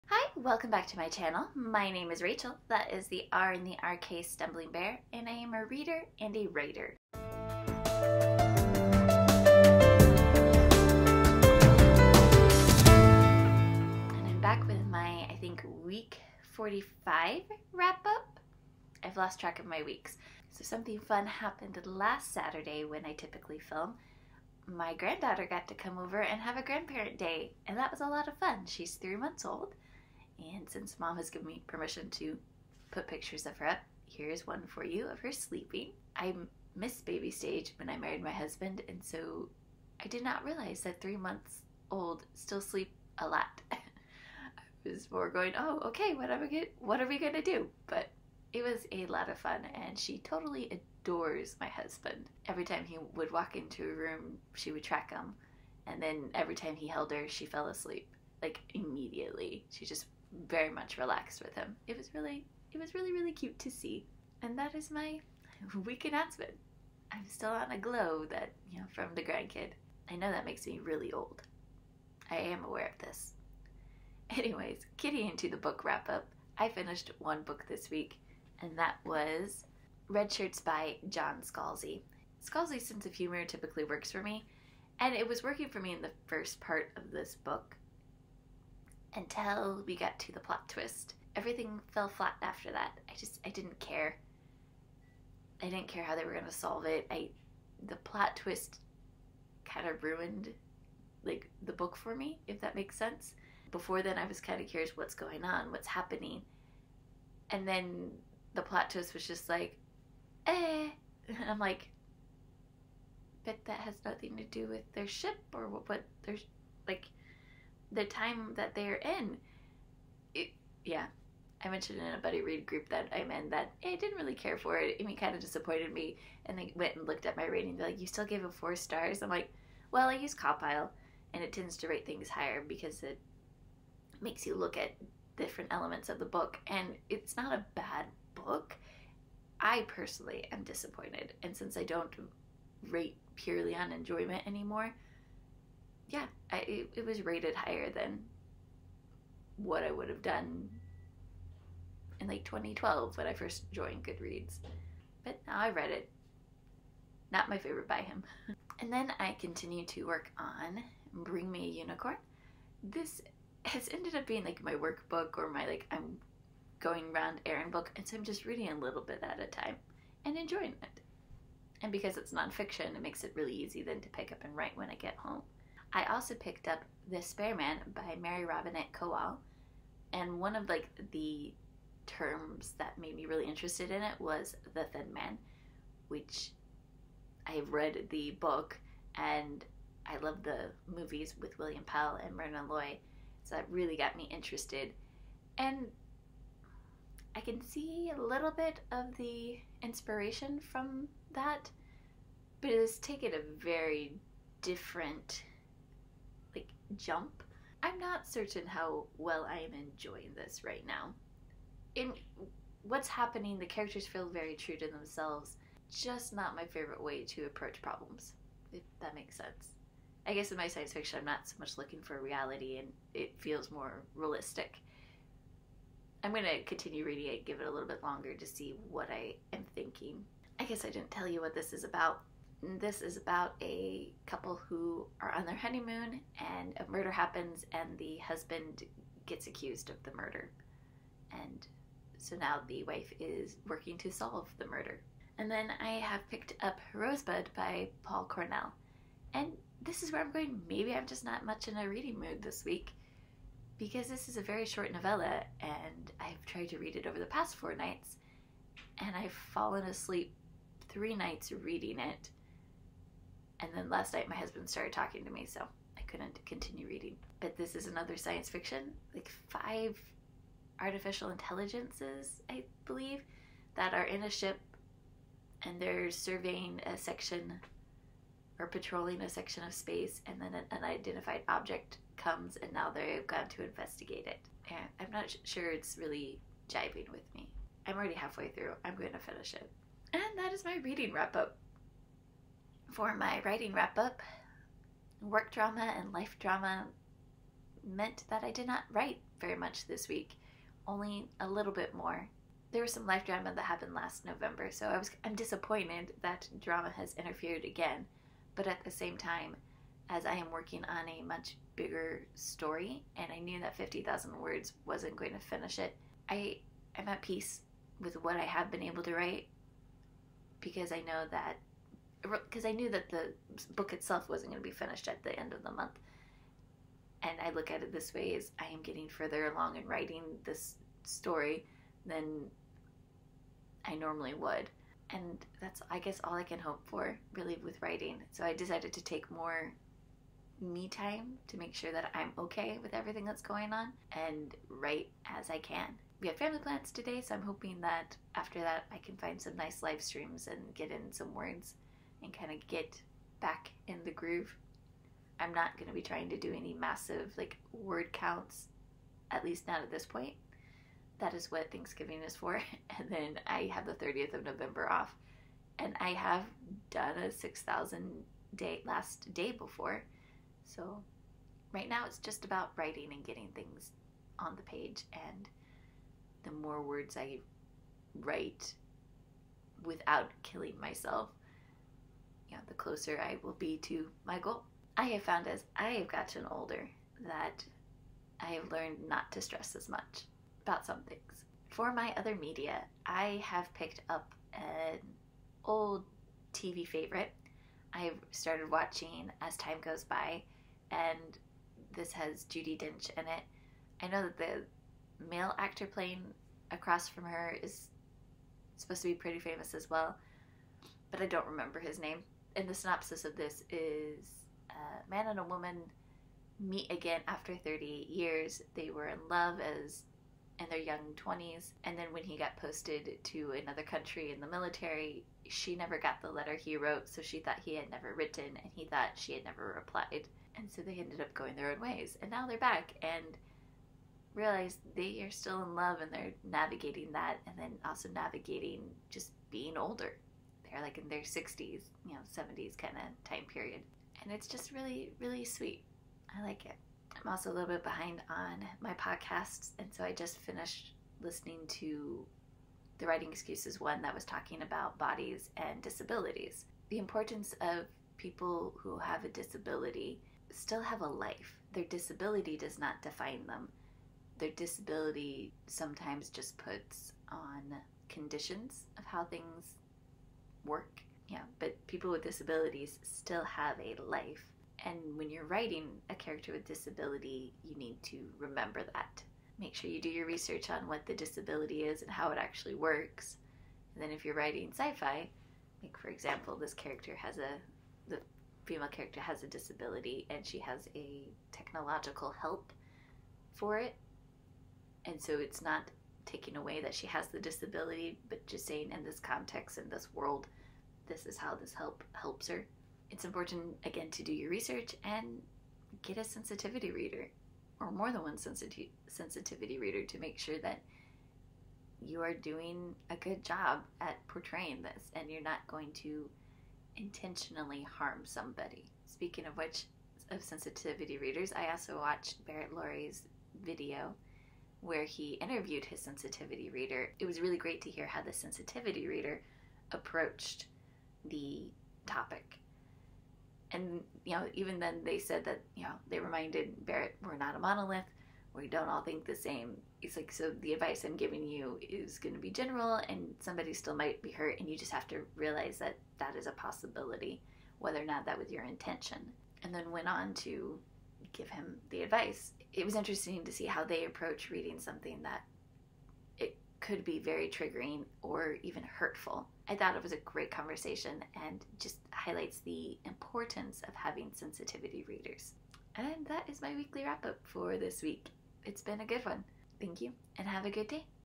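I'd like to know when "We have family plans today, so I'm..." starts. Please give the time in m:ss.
5:46.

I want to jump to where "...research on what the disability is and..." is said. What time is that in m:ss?
8:00.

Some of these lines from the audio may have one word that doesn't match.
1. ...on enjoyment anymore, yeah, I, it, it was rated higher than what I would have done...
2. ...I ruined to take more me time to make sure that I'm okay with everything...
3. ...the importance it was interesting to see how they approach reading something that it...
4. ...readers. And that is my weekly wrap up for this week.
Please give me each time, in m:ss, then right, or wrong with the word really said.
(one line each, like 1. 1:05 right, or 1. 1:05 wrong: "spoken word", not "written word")
1. 2:23 right
2. 5:38 wrong: "decided", not "ruined"
3. 9:11 wrong: "advice", not "importance"
4. 9:25 right.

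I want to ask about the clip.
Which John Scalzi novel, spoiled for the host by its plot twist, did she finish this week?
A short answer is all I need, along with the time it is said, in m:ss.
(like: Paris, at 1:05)
Redshirts, at 1:20.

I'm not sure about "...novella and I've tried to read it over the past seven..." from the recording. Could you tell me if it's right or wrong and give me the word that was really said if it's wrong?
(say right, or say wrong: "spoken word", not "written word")
wrong: "four", not "seven".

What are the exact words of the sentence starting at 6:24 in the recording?
I have found as I have gotten older that I have learned not to stress as much about some things.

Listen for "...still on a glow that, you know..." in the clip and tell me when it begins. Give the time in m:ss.
1:07.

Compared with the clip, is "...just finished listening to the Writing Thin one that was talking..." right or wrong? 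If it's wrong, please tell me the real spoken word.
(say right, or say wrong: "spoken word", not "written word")
wrong: "Excuses", not "Thin".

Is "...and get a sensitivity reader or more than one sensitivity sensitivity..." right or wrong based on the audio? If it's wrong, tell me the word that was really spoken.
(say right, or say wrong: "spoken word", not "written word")
right.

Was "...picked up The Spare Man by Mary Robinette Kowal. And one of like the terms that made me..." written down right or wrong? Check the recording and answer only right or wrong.
right.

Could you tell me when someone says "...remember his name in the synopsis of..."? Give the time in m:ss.
6:51.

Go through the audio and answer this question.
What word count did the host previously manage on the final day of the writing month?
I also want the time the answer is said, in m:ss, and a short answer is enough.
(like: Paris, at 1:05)
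6,000, at 6:07.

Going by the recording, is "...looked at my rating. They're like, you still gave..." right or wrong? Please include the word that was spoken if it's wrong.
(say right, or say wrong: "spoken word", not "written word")
right.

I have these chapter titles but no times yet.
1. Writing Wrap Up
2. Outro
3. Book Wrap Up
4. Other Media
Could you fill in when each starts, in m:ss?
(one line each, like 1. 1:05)
1. 4:52
2. 9:25
3. 1:14
4. 6:31.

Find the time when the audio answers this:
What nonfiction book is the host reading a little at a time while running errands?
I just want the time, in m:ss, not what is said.
2:41.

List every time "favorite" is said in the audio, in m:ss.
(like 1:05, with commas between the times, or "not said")
2:37, 3:36, 6:36.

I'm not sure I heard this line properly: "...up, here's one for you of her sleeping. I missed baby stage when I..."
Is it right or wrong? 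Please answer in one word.
right.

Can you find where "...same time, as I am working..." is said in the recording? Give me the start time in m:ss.
5:08.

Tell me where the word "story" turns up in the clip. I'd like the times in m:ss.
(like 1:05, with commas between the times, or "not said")
5:12, 5:31.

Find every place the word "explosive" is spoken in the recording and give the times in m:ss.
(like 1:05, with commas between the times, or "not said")
not said.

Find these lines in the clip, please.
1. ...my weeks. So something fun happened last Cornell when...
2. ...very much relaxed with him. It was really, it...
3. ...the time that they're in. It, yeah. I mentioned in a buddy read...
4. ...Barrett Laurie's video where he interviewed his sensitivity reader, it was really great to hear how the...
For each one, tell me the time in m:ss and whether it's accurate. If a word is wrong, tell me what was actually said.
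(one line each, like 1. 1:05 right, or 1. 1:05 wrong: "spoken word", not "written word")
1. 0:19 wrong: "Saturday", not "Cornell"
2. 1:00 right
3. 1:57 right
4. 8:42 right.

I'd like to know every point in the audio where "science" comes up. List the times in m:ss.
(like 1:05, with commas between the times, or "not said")
3:40, 4:28.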